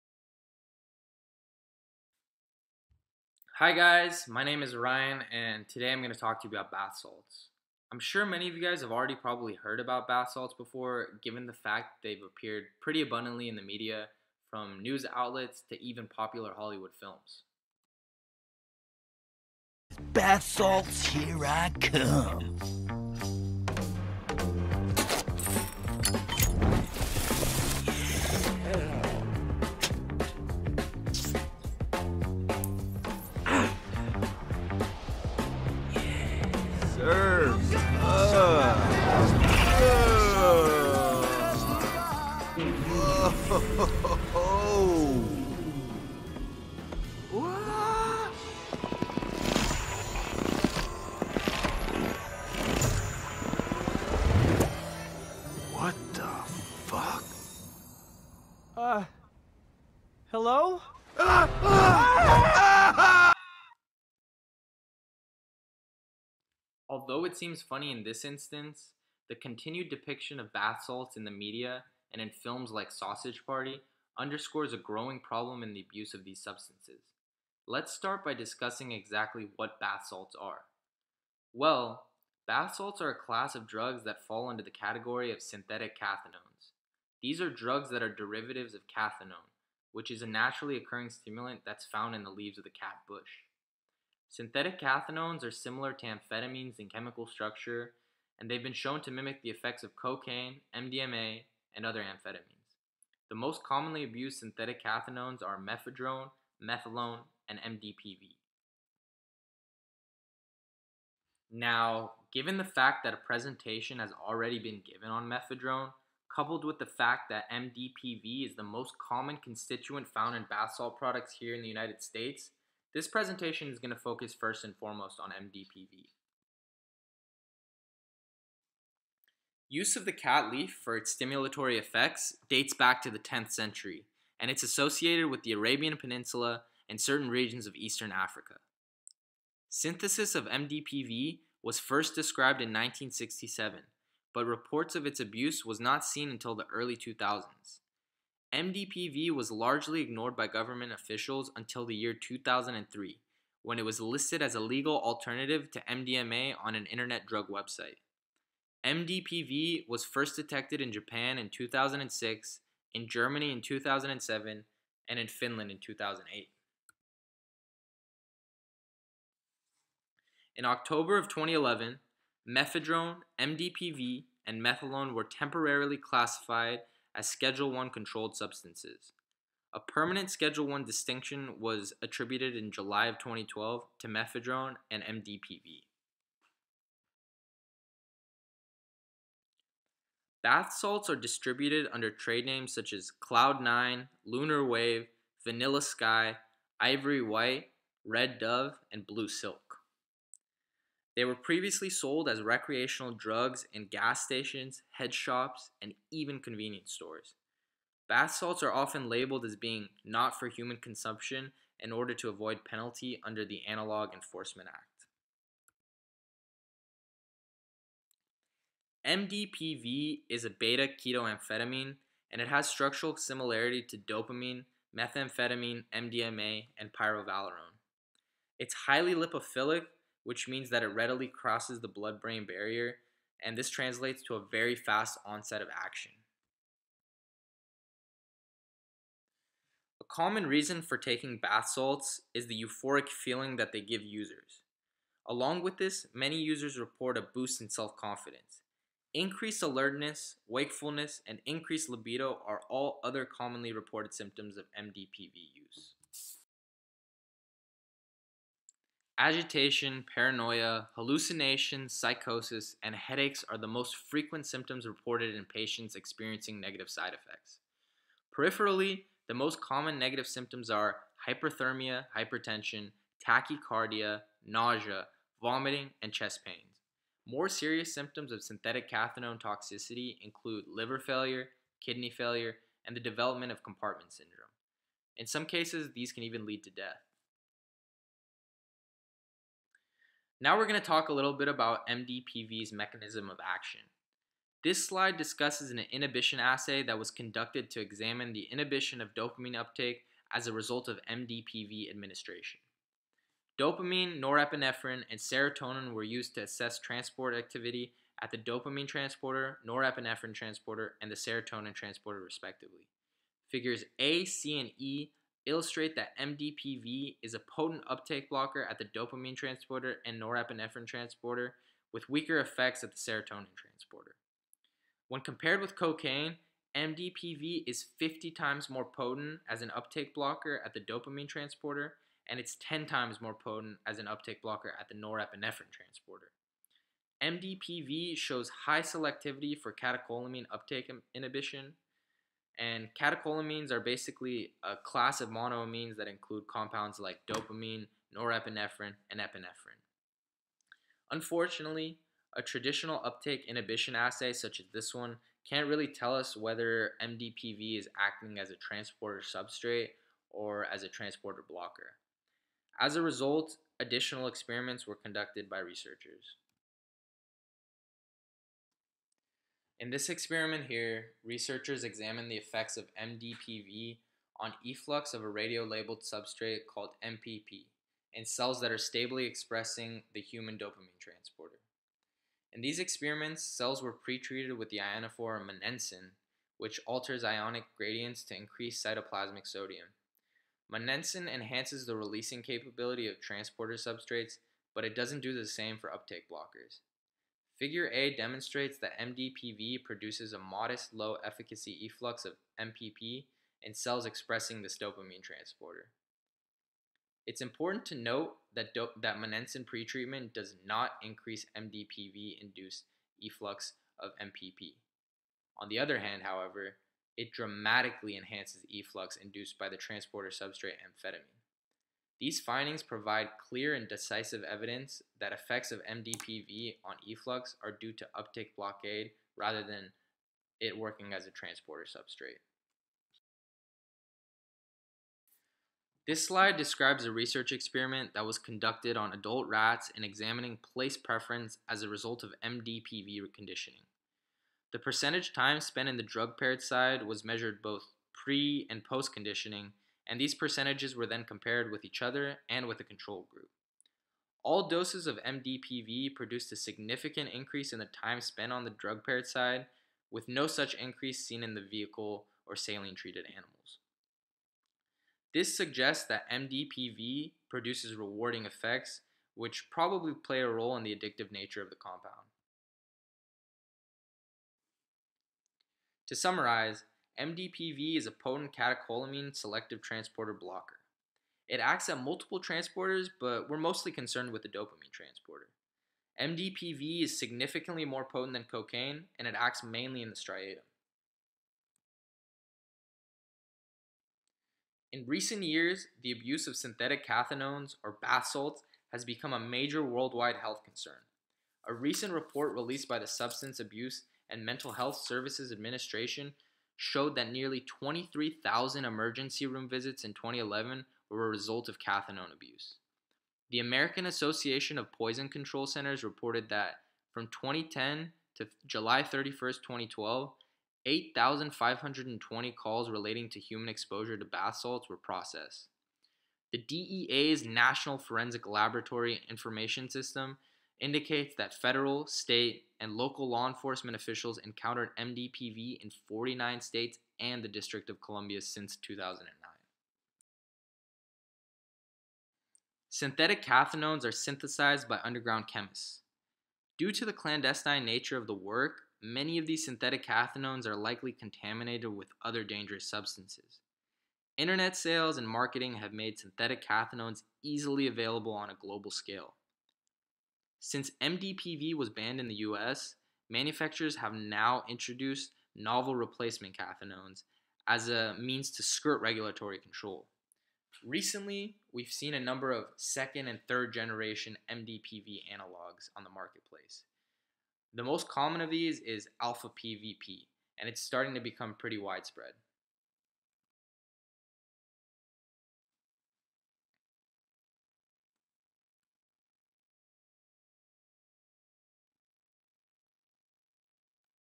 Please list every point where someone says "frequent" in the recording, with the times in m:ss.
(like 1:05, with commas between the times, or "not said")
4:24.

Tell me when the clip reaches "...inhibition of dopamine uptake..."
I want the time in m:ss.
4:58.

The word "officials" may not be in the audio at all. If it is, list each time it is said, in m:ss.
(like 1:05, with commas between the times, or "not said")
2:30, 8:53.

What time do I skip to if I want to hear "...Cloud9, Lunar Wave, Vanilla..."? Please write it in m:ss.
3:13.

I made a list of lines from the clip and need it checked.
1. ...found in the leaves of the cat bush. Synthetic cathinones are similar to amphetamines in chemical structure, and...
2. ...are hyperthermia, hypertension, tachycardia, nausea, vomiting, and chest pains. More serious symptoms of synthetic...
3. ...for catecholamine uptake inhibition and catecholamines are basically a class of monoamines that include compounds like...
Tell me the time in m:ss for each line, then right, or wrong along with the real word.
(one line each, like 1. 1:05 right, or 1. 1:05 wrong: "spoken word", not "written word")
1. 1:31 right
2. 4:30 right
3. 5:39 right.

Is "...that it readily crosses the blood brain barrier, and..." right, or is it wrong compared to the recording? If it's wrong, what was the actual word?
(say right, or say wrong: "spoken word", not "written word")
right.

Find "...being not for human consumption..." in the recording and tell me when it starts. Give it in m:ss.
3:29.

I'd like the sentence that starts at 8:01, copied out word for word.
It acts at multiple transporters, but we're mostly concerned with the dopamine transporter.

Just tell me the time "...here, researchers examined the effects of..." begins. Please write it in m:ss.
6:10.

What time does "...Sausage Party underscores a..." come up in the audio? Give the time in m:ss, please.
1:12.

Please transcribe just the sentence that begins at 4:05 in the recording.
Along with this, many users report a boost in self confidence.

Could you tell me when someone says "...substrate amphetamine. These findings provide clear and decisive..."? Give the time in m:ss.
7:00.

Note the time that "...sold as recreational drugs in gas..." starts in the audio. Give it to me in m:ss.
3:21.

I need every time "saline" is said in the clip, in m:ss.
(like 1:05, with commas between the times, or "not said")
7:42.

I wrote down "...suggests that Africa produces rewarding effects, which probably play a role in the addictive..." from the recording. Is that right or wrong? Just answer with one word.
wrong.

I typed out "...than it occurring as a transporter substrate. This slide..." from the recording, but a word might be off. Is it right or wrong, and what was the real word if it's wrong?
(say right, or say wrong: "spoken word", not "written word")
wrong: "working", not "occurring".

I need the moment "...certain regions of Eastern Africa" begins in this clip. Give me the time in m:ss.
2:16.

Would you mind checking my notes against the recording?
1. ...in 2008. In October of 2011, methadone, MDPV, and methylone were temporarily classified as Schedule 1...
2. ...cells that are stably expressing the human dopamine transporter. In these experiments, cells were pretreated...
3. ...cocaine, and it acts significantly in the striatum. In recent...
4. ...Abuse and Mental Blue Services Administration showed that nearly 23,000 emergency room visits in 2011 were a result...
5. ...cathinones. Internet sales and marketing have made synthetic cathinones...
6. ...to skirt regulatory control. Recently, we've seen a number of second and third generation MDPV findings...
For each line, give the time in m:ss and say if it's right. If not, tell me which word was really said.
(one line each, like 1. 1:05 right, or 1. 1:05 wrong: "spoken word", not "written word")
1. 2:45 right
2. 6:18 right
3. 8:08 wrong: "mainly", not "significantly"
4. 8:23 wrong: "Health", not "Blue"
5. 9:12 wrong: "substances", not "cathinones"
6. 9:28 wrong: "analogs", not "findings".